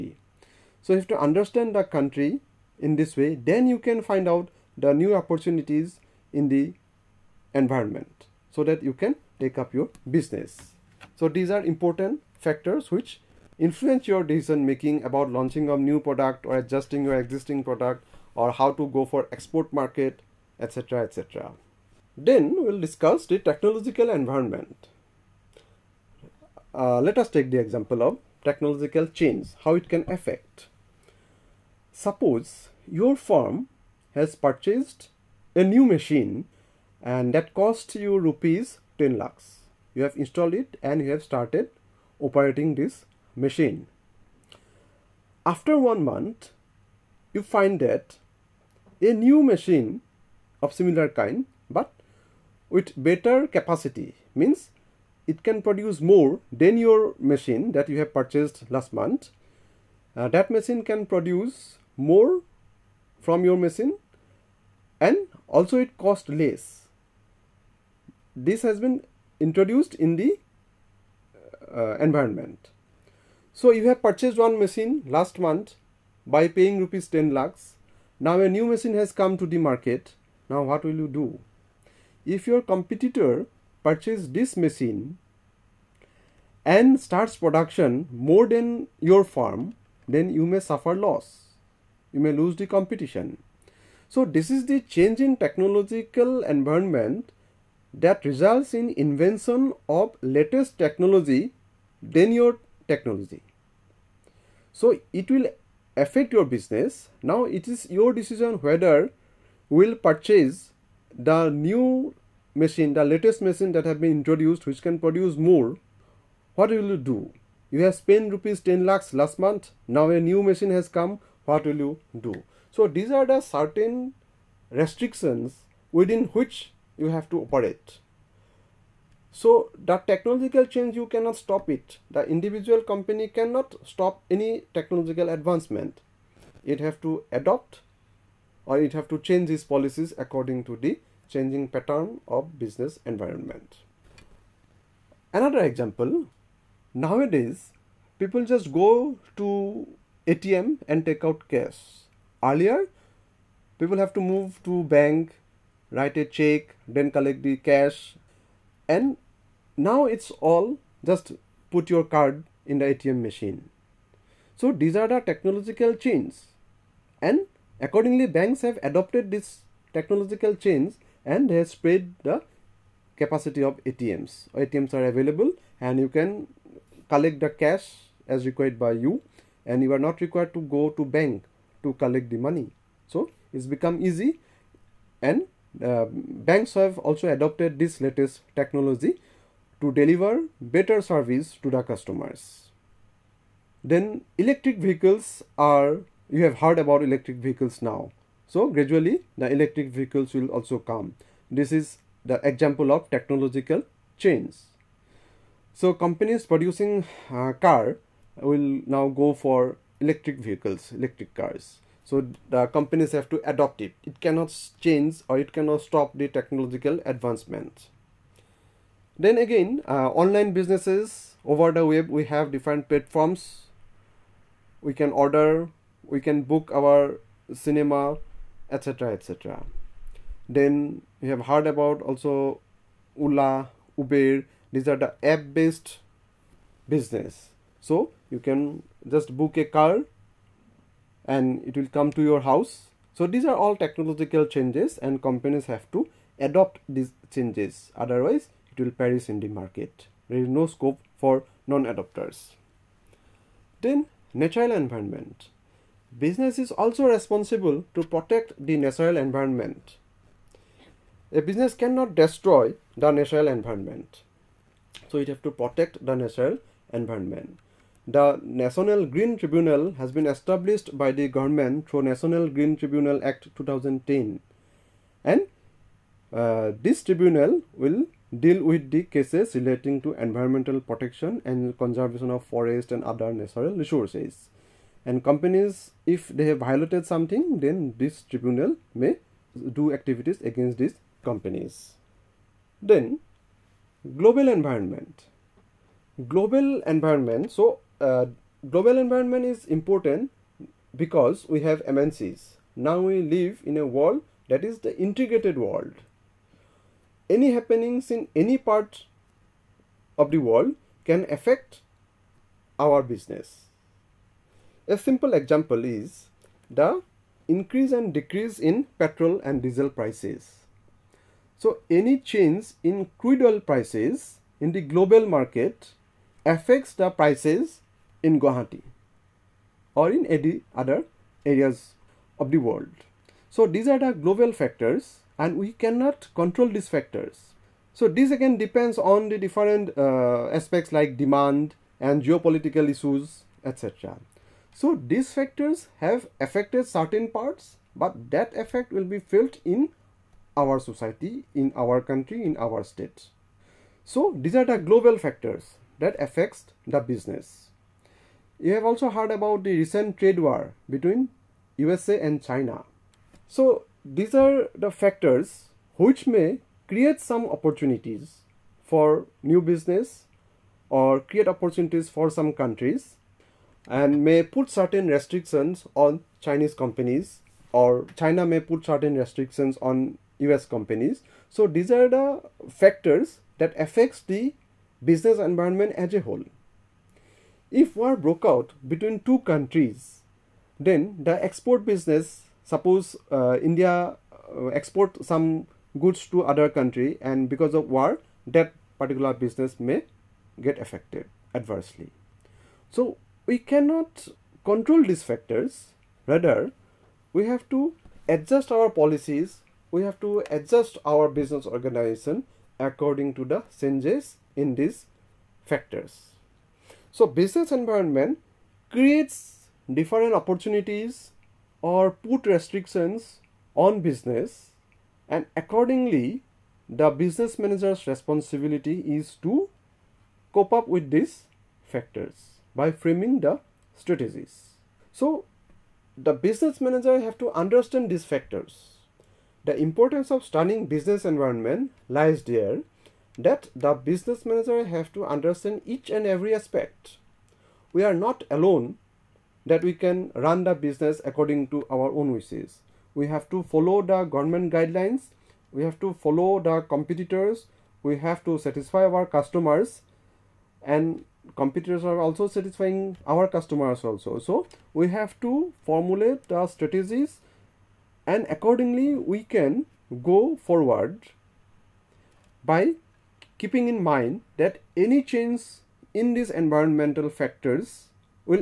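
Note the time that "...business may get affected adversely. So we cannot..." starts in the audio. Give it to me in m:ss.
6:39.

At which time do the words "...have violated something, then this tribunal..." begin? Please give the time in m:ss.
4:46.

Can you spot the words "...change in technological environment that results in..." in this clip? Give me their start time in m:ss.
1:34.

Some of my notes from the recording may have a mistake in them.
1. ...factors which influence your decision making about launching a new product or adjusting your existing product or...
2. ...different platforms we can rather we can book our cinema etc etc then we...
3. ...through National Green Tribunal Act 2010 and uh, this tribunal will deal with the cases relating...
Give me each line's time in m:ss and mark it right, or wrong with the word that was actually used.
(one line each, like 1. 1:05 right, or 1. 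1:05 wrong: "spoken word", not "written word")
1. 0:12 right
2. 3:42 wrong: "order", not "rather"
3. 4:31 right.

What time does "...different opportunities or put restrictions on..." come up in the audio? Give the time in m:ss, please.
6:59.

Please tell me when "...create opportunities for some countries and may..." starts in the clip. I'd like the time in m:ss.
6:11.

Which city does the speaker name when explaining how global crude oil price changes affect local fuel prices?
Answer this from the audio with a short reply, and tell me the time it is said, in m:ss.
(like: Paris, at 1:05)
Guwahati, at 5:28.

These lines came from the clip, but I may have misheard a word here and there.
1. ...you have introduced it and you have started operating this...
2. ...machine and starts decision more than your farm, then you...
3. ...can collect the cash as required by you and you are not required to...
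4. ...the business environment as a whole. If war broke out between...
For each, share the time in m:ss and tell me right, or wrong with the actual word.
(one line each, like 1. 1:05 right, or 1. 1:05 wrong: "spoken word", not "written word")
1. 0:39 wrong: "installed", not "introduced"
2. 1:24 wrong: "production", not "decision"
3. 2:56 right
4. 6:24 right.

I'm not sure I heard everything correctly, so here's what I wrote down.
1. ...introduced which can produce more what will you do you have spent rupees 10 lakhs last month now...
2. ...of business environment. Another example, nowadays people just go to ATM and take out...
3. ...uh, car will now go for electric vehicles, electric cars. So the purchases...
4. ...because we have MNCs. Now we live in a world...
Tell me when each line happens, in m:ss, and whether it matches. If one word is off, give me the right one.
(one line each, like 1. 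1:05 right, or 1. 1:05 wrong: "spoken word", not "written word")
1. 1:54 right
2. 2:22 right
3. 3:27 wrong: "companies", not "purchases"
4. 5:00 right.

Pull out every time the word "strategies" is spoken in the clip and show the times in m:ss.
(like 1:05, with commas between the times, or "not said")
7:13, 7:46.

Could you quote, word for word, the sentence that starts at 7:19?
The importance of stunning business environment lies there that the business manager have to understand each and every aspect.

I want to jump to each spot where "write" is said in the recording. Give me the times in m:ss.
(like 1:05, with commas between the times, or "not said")
2:35.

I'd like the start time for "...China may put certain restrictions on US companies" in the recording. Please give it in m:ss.
6:18.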